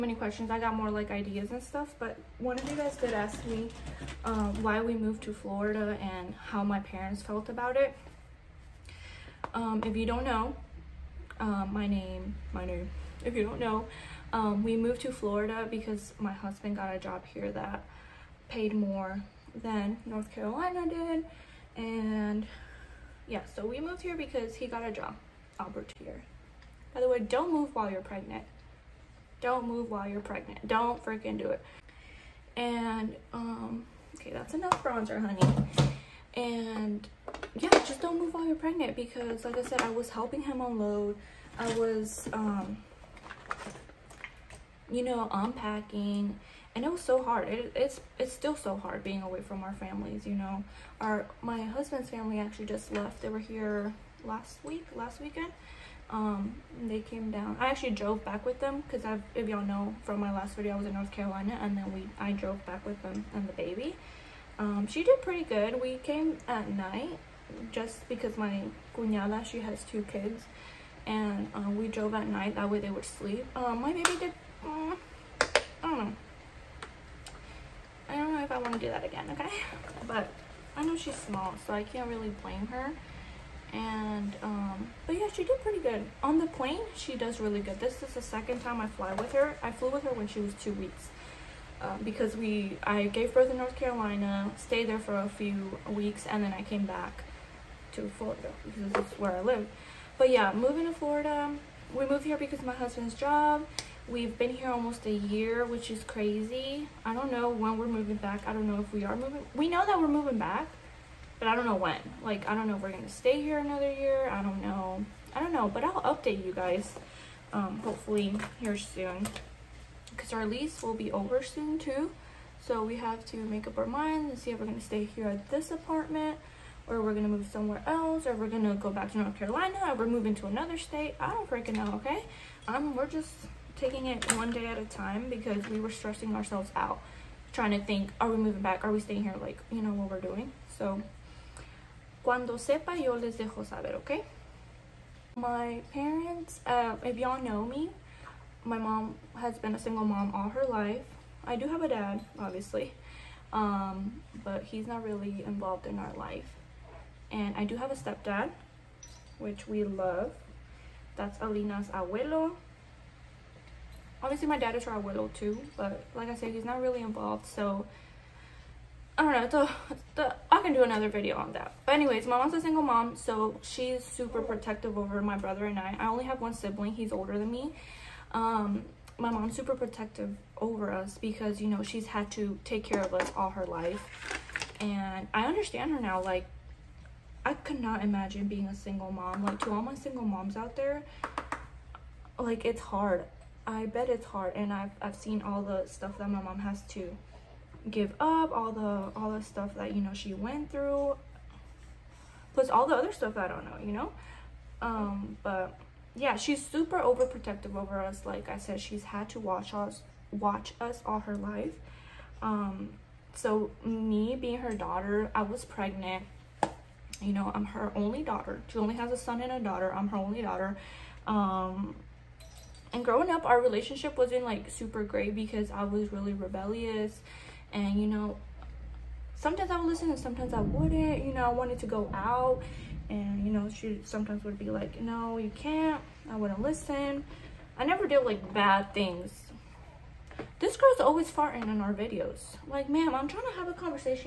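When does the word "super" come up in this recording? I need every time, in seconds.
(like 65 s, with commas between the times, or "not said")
174 s, 179 s, 206 s, 224 s.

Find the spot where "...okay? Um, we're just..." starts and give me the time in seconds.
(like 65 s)
131 s.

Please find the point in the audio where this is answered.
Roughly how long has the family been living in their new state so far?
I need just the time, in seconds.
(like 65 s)
104 s.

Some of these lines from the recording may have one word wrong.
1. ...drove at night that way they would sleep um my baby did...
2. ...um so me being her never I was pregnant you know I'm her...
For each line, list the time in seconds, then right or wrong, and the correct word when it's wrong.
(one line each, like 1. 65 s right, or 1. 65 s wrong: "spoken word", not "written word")
1. 71 s right
2. 212 s wrong: "daughter", not "never".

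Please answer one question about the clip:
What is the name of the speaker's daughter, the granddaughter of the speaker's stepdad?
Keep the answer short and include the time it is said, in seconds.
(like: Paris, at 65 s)
Alina, at 161 s.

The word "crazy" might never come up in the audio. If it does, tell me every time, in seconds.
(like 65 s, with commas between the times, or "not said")
106 s.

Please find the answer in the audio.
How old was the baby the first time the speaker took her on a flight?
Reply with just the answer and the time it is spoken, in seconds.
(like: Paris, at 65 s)
2 weeks, at 90 s.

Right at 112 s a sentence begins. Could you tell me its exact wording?
Like, I don't know if we're going to stay here another year.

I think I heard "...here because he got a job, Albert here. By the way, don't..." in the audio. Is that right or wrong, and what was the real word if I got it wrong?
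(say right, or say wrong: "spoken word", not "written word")
right.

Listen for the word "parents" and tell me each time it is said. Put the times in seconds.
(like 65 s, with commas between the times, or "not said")
6 s, 145 s.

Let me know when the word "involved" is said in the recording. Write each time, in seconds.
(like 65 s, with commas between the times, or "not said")
155 s, 167 s.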